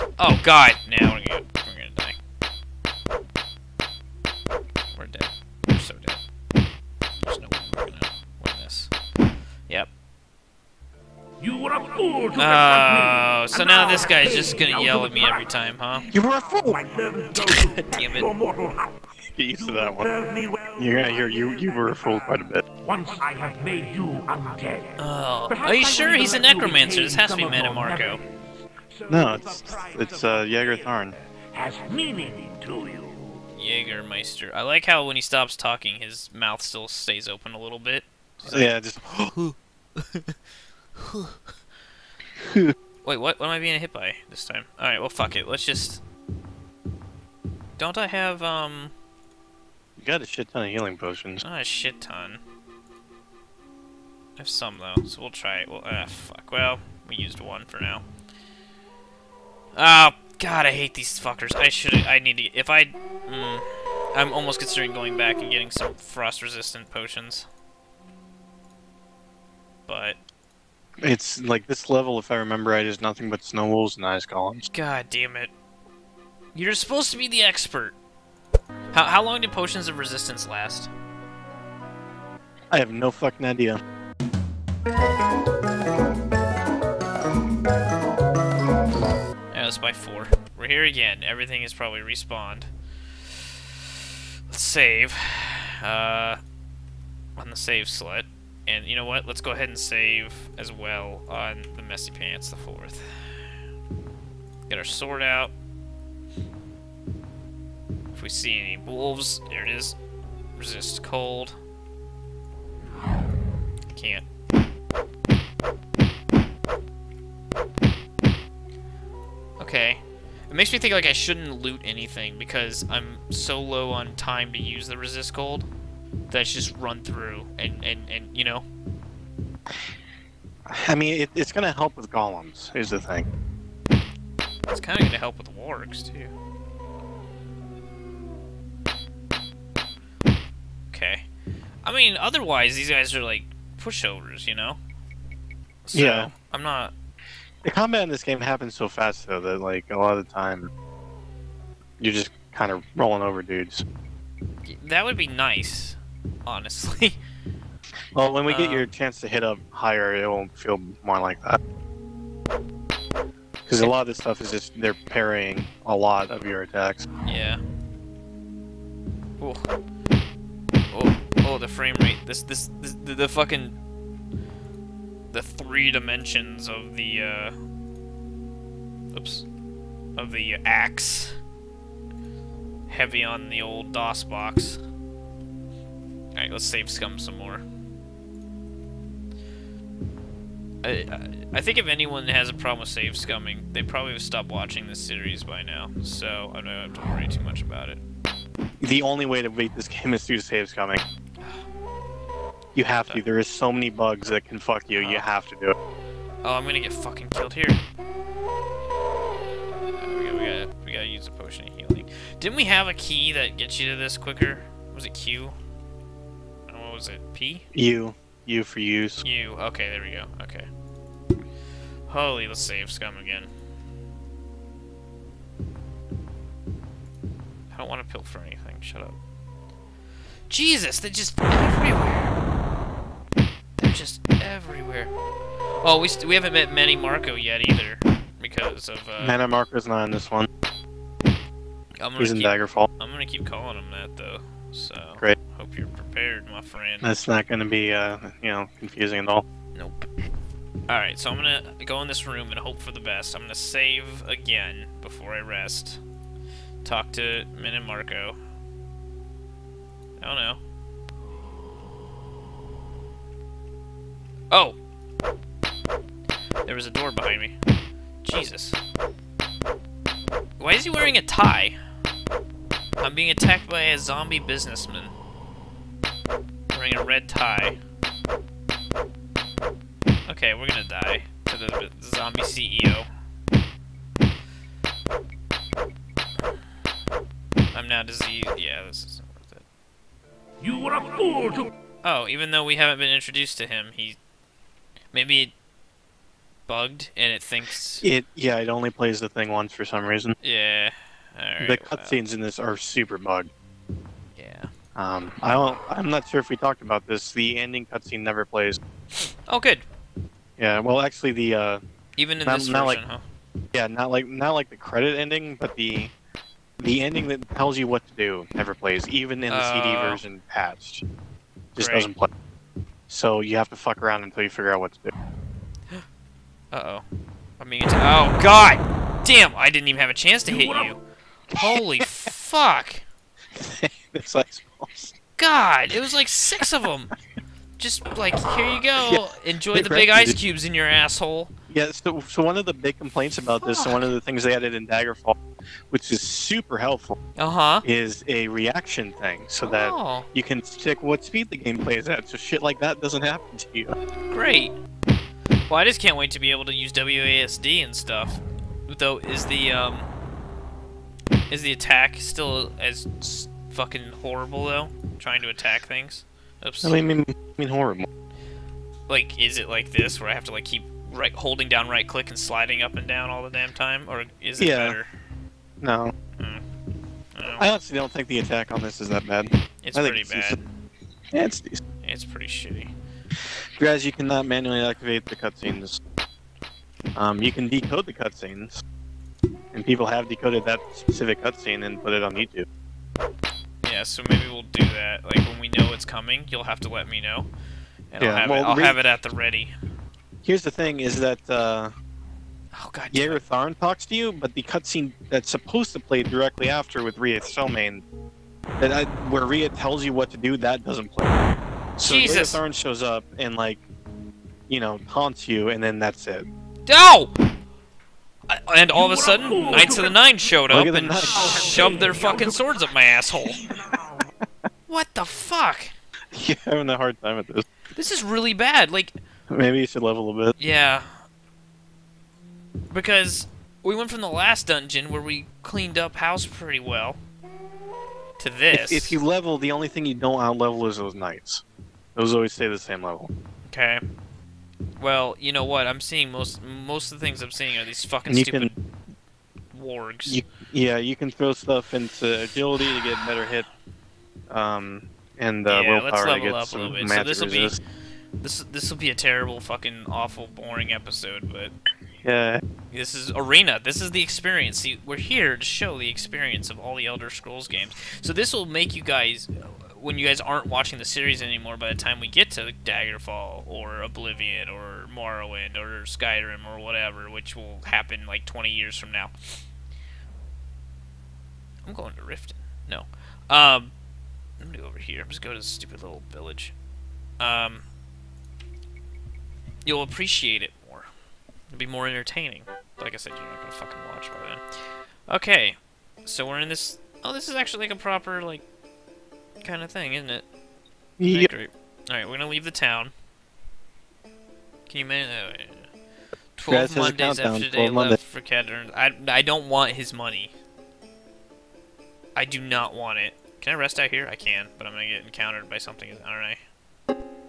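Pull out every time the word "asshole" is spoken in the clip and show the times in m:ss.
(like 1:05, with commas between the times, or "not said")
5:40, 7:03.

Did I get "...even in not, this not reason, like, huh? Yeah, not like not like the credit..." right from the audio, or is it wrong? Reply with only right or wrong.
wrong.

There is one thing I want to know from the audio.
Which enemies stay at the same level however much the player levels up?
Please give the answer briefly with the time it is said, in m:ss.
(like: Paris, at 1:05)
those knights, at 7:20.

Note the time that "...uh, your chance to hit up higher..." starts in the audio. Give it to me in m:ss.
2:38.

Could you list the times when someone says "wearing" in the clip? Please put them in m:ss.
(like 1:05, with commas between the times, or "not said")
4:30, 4:36.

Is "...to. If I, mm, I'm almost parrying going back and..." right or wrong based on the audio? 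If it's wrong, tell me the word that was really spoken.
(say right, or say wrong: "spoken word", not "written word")
wrong: "considering", not "parrying".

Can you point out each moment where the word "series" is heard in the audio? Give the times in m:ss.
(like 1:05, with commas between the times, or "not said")
3:14, 7:51.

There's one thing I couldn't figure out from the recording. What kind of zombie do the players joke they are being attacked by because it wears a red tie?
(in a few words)
zombie businessman.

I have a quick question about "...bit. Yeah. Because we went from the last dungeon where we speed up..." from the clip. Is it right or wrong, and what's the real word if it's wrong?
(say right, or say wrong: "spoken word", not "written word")
wrong: "cleaned", not "speed".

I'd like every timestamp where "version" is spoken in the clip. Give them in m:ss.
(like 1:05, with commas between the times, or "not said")
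5:12, 5:20.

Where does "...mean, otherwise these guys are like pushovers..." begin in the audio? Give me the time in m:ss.
2:21.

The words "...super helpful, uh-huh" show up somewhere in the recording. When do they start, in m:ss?
5:46.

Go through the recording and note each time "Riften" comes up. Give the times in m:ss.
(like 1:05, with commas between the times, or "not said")
8:02.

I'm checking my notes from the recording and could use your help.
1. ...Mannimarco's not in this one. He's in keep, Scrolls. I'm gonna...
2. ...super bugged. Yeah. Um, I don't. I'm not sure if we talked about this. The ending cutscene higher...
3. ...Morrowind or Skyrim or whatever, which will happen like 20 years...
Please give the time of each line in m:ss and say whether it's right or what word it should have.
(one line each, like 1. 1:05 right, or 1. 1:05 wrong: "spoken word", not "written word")
1. 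3:59 wrong: "Daggerfall", not "Scrolls"
2. 5:02 wrong: "never", not "higher"
3. 7:55 right.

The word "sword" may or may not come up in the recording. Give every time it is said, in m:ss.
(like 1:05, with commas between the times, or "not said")
1:44, 7:02.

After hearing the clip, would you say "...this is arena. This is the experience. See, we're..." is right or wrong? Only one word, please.
right.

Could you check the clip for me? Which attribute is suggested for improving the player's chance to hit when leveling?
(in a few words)
agility.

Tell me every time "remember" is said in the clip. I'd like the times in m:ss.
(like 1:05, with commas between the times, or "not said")
1:12.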